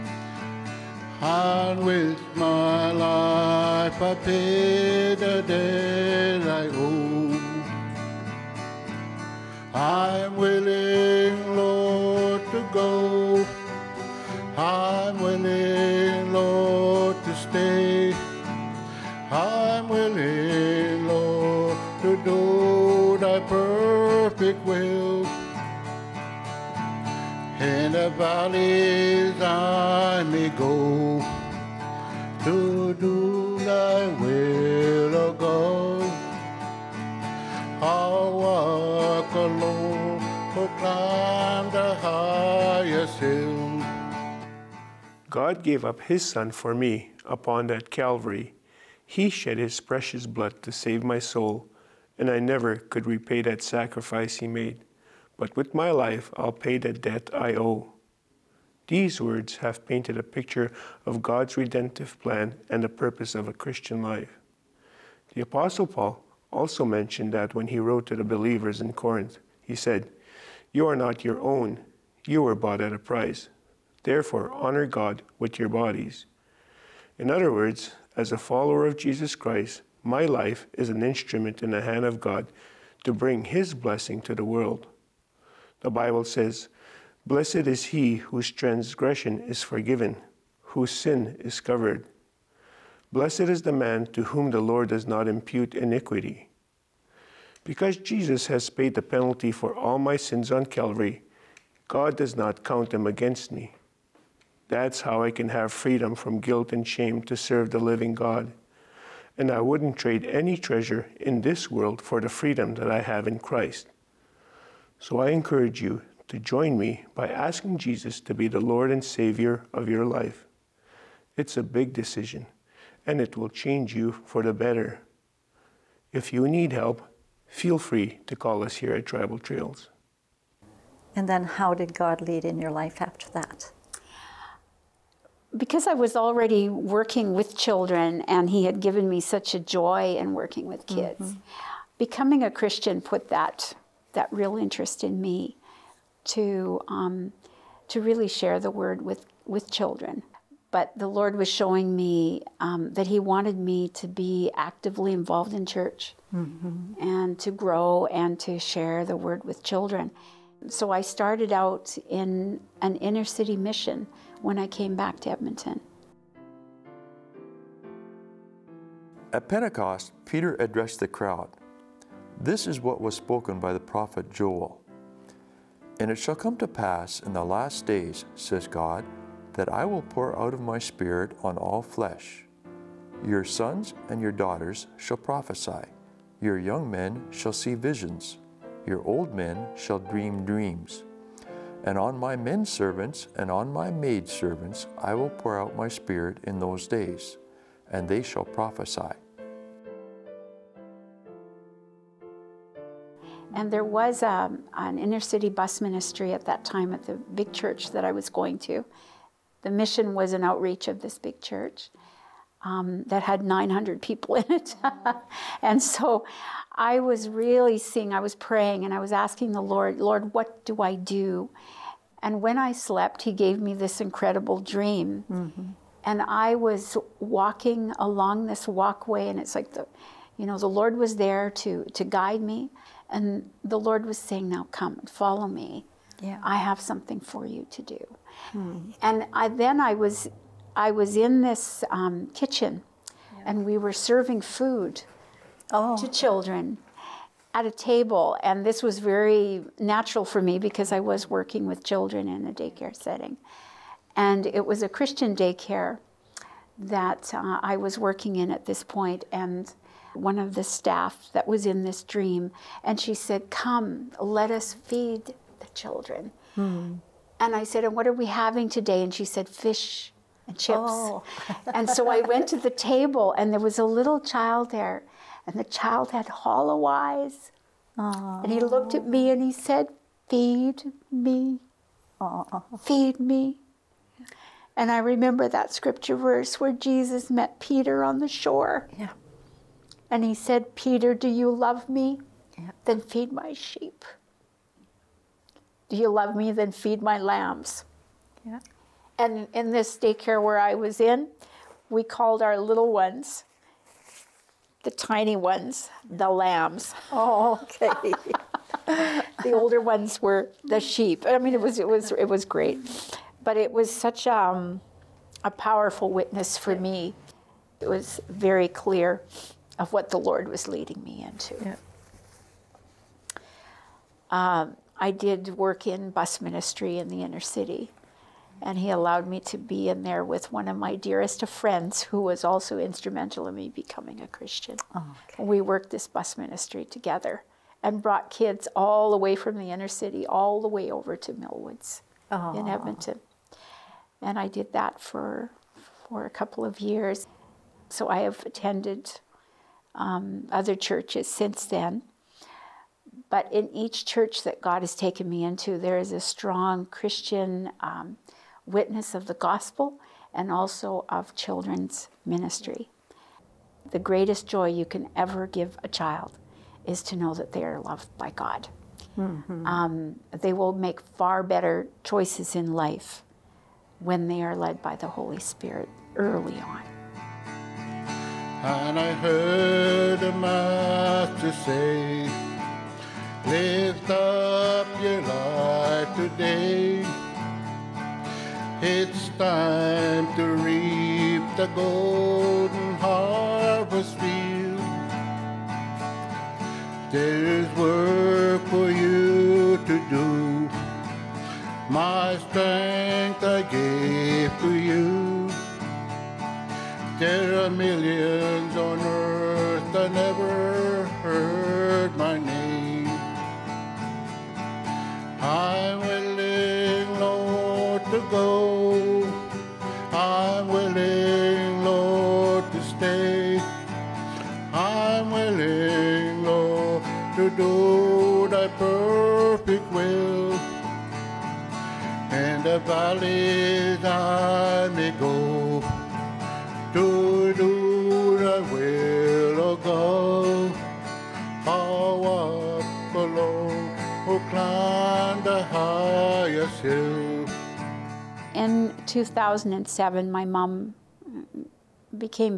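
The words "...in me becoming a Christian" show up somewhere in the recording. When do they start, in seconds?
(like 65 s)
333 s.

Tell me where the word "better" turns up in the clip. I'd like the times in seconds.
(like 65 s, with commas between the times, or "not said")
124 s, 371 s.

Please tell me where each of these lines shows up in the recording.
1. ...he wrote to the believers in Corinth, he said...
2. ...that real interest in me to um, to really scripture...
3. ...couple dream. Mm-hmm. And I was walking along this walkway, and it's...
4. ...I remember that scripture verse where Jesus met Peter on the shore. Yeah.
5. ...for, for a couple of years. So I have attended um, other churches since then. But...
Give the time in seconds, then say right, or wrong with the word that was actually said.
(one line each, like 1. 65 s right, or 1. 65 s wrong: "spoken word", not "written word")
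1. 67 s right
2. 144 s wrong: "share", not "scripture"
3. 223 s wrong: "incredible", not "couple"
4. 284 s right
5. 344 s right.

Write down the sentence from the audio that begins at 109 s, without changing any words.
And I wouldn't trade any treasure in this world for the freedom that I have in Christ.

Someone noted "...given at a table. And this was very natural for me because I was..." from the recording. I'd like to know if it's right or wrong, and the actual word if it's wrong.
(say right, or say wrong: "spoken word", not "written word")
wrong: "children", not "given".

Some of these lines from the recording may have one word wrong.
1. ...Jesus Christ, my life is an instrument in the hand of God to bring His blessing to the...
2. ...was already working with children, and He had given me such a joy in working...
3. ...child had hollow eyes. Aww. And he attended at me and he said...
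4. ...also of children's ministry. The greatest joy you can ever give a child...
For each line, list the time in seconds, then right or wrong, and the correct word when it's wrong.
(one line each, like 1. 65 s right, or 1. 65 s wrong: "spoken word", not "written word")
1. 78 s right
2. 135 s right
3. 275 s wrong: "looked", not "attended"
4. 360 s right.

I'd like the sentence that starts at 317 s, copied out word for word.
It was very clear of what the Lord was leading me into.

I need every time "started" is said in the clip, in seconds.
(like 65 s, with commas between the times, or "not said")
160 s.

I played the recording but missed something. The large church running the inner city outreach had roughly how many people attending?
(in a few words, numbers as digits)
900.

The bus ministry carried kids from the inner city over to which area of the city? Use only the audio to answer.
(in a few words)
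Millwoods.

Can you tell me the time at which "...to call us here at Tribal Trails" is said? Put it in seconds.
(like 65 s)
128 s.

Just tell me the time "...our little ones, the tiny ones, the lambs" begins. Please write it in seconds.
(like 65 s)
302 s.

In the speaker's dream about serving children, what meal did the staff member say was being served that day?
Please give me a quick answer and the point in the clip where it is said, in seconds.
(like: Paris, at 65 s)
Fish and chips, at 269 s.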